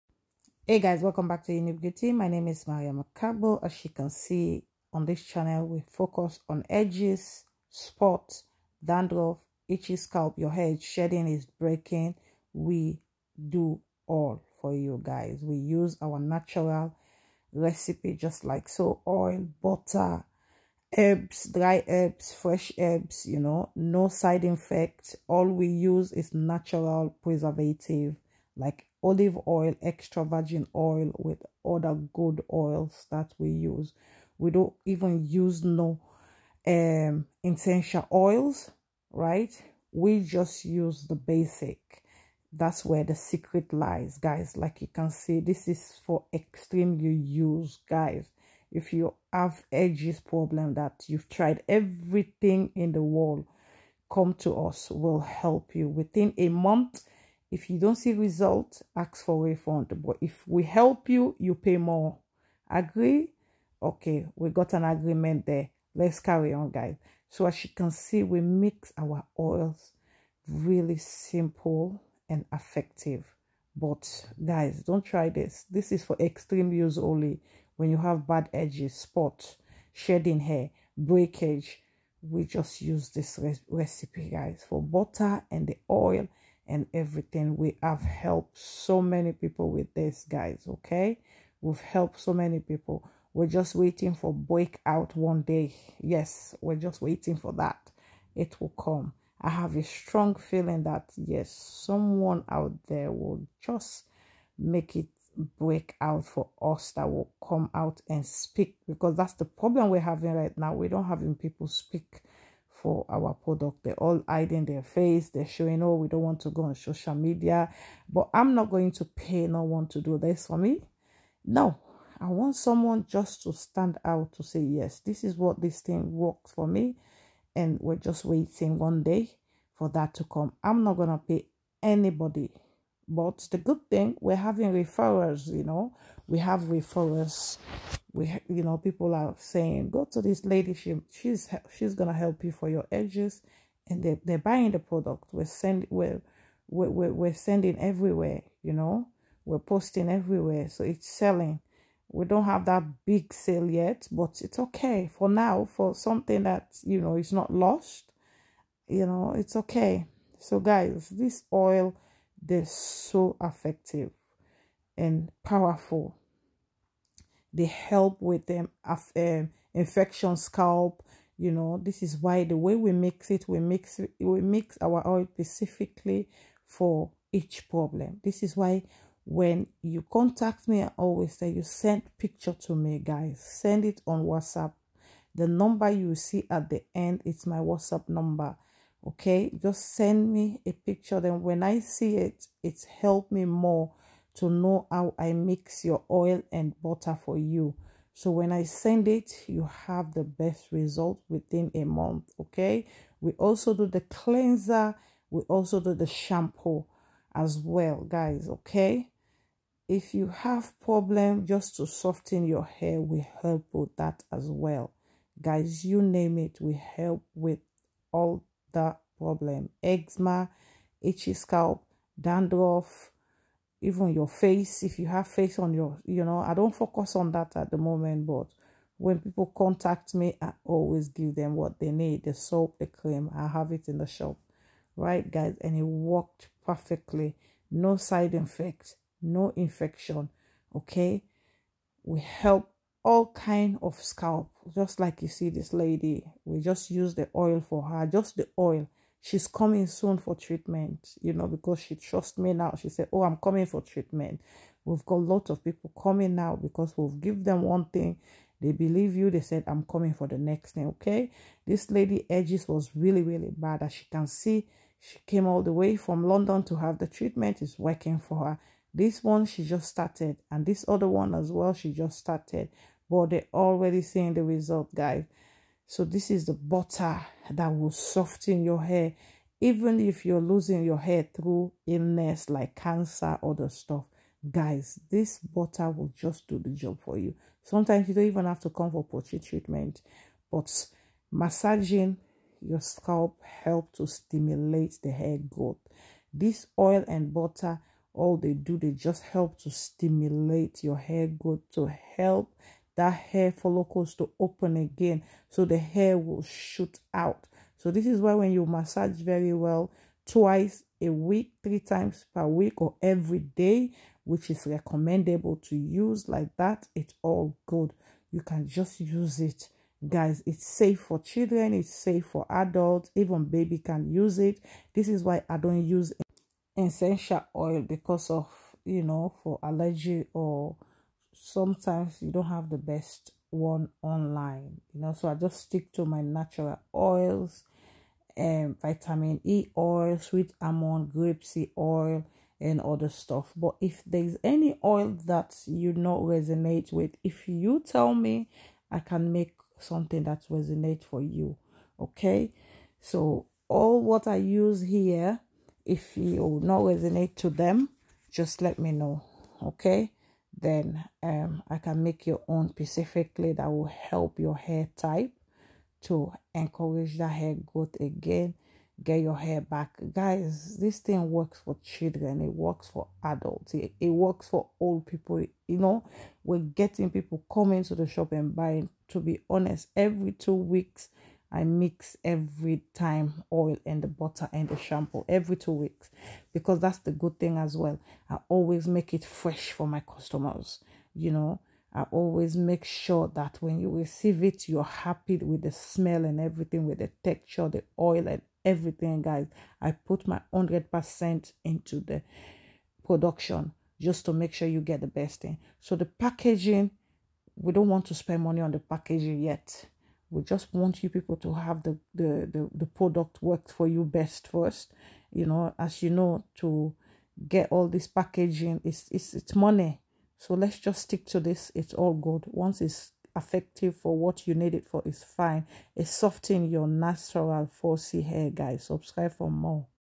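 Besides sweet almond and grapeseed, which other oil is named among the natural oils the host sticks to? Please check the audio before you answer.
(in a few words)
vitamin E oil.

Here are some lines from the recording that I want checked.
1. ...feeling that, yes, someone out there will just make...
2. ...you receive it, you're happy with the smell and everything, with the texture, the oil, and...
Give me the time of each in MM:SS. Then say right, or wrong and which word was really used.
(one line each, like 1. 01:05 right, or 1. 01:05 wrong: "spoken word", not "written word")
1. 01:40 right
2. 06:33 right.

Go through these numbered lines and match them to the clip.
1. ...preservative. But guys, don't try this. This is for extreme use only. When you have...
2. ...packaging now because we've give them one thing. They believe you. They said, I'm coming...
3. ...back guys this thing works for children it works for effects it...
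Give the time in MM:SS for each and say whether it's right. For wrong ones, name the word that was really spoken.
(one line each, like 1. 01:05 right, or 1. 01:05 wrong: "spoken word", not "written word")
1. 01:12 wrong: "effective", not "preservative"
2. 04:15 wrong: "coming", not "packaging"
3. 06:09 wrong: "adults", not "effects".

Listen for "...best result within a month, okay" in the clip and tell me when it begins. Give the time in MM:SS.
03:20.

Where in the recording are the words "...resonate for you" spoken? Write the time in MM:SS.
05:50.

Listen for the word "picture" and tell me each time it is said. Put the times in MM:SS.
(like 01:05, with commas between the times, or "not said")
03:02, 03:10.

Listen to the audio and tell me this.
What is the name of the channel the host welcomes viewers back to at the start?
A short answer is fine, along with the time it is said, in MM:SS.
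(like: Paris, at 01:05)
Unique Beauty, at 00:01.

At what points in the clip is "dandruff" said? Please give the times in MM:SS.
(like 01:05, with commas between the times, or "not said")
00:08, 03:42.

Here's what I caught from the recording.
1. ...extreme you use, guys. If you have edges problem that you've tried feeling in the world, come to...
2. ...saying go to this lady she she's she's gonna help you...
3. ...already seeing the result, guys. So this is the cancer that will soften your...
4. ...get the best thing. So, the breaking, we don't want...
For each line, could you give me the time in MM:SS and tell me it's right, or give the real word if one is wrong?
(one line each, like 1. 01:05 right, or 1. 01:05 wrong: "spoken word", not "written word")
1. 00:46 wrong: "everything", not "feeling"
2. 02:19 right
3. 04:33 wrong: "butter", not "cancer"
4. 06:44 wrong: "packaging", not "breaking".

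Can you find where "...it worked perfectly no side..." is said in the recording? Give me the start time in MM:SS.
03:55.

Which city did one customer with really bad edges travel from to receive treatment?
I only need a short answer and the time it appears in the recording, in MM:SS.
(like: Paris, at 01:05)
London, at 04:26.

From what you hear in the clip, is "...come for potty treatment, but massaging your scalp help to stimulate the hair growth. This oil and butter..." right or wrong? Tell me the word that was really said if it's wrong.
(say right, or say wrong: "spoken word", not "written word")
right.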